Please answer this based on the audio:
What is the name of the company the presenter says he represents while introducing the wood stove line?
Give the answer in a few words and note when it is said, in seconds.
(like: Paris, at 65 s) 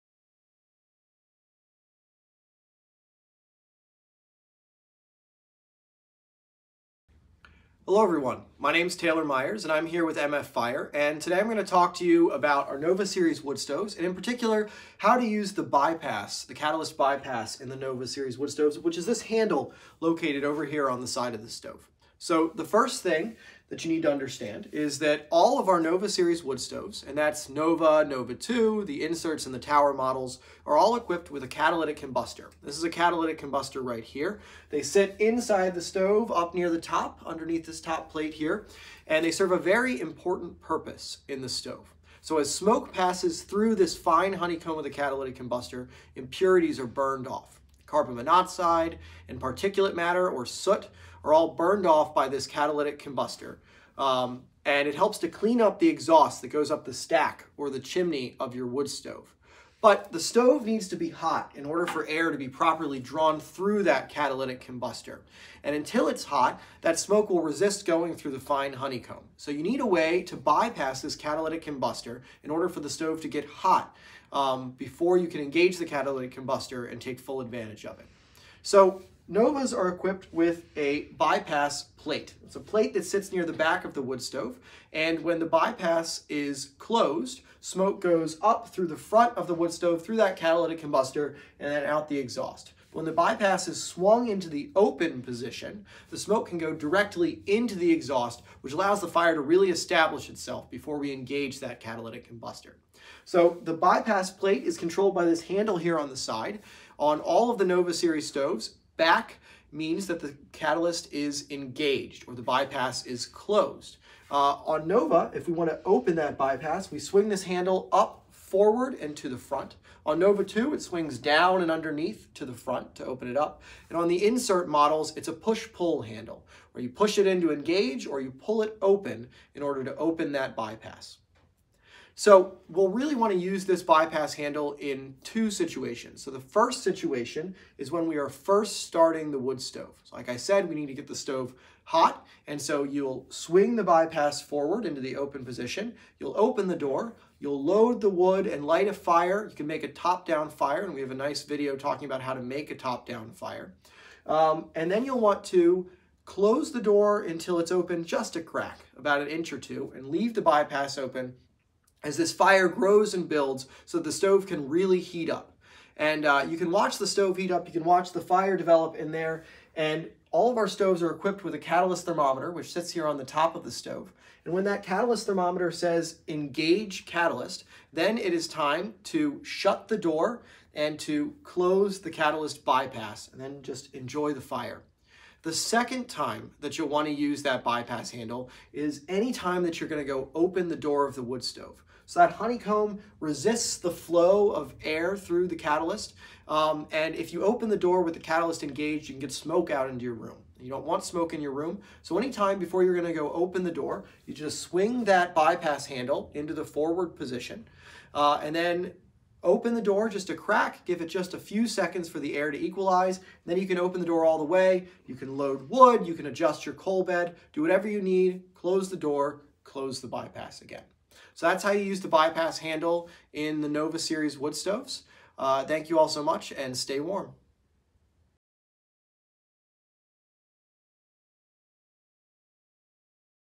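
MF Fire, at 10 s.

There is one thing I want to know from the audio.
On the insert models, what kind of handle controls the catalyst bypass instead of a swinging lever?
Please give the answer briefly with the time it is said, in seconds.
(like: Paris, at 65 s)
push-pull handle, at 125 s.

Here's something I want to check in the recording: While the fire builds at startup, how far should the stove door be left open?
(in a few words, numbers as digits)
an inch or two.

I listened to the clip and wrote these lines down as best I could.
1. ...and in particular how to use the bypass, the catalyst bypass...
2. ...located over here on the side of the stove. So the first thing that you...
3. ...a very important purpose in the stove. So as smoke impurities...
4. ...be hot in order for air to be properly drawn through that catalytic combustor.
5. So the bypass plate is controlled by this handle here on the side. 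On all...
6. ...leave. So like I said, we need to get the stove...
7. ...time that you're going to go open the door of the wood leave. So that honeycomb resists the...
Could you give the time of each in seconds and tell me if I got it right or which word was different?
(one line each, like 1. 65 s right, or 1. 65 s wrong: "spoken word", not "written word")
1. 13 s right
2. 19 s right
3. 39 s wrong: "passes", not "impurities"
4. 60 s right
5. 103 s right
6. 139 s wrong: "stove", not "leave"
7. 189 s wrong: "stove", not "leave".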